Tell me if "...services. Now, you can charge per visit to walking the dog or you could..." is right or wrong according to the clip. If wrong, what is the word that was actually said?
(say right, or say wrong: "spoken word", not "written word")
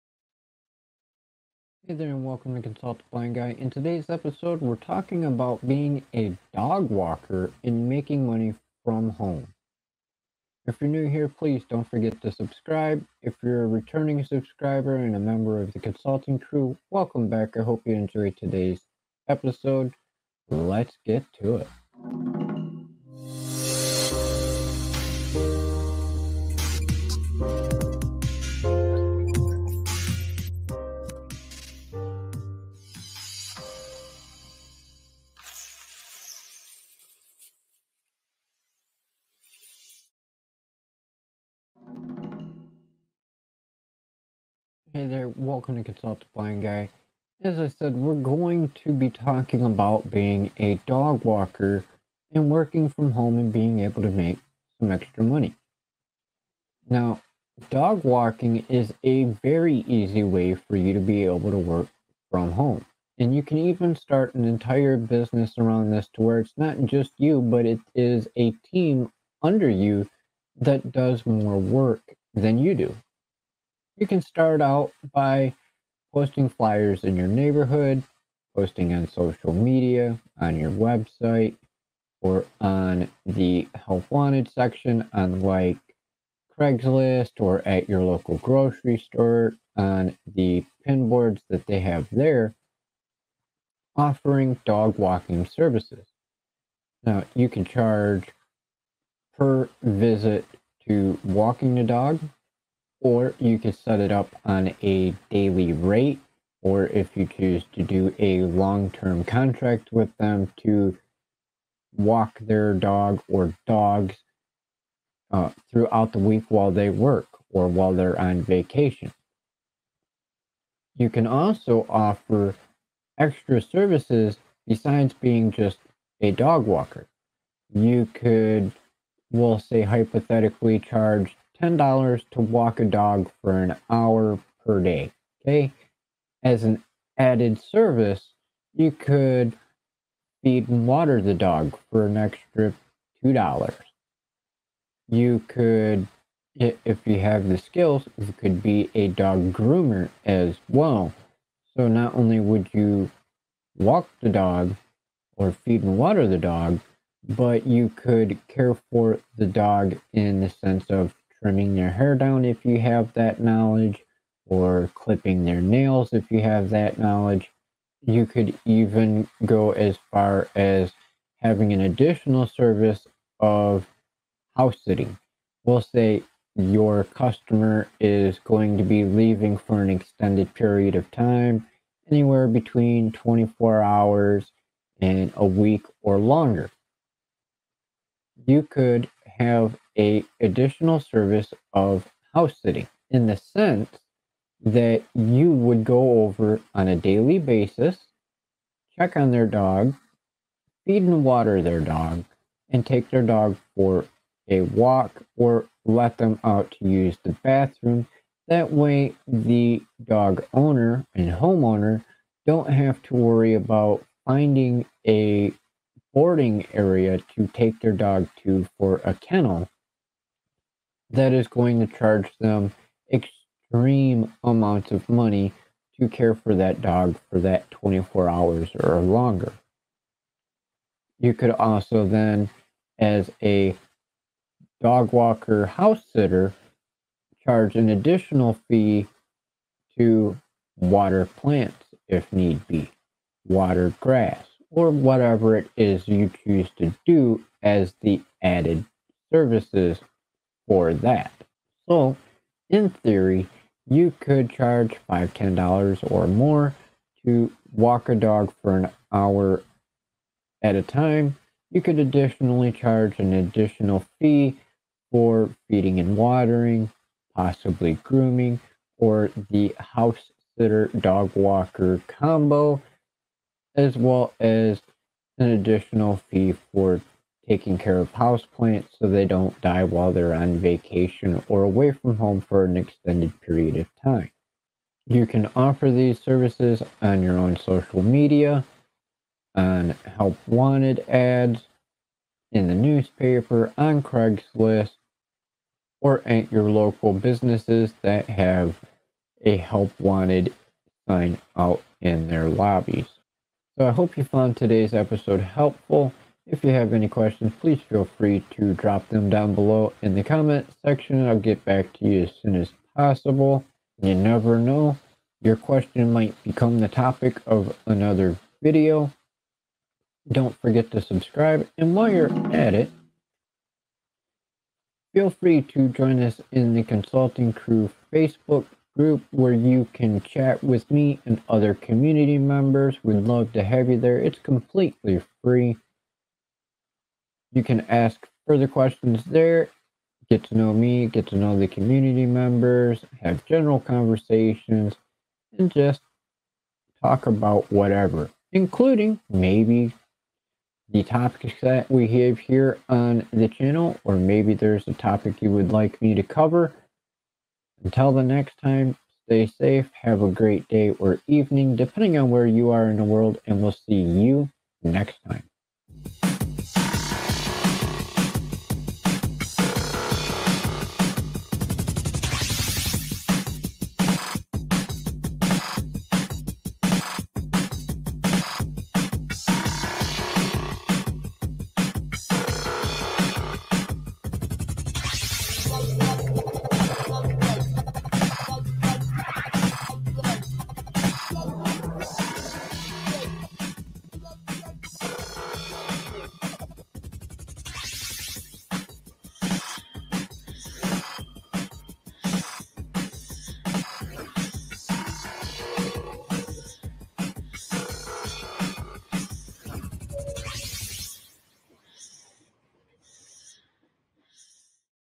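right.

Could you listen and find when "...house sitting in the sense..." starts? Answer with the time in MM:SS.
03:12.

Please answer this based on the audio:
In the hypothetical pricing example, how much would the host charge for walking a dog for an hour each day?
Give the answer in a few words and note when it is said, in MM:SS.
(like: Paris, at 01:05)
$10, at 02:11.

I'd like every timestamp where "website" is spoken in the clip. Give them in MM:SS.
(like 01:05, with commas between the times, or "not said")
01:20.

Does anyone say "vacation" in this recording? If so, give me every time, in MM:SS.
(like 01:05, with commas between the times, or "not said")
01:58, 04:40.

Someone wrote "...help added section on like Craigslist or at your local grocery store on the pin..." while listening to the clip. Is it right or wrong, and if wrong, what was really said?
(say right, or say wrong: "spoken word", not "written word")
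wrong: "wanted", not "added".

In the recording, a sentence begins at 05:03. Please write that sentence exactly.
So I hope you found today's episode helpful.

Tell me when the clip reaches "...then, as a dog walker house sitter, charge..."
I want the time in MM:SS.
03:52.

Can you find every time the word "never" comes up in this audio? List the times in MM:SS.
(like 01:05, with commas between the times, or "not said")
05:14.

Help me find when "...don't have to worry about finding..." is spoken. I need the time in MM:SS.
03:32.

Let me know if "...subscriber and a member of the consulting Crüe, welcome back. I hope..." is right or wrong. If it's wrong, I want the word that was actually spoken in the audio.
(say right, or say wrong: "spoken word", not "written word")
right.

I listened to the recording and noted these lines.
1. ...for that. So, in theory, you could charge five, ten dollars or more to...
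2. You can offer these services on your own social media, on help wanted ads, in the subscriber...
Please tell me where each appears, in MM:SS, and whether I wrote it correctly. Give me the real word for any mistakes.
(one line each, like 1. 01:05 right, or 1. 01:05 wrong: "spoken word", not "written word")
1. 04:10 right
2. 04:45 wrong: "newspaper", not "subscriber".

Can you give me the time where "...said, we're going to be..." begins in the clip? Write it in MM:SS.
00:47.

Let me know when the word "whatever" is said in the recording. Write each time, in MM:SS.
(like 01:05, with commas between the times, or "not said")
04:04, 05:47.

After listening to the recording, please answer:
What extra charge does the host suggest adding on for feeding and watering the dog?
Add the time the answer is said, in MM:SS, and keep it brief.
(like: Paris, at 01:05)
$2, at 02:23.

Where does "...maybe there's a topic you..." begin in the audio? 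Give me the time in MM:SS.
05:54.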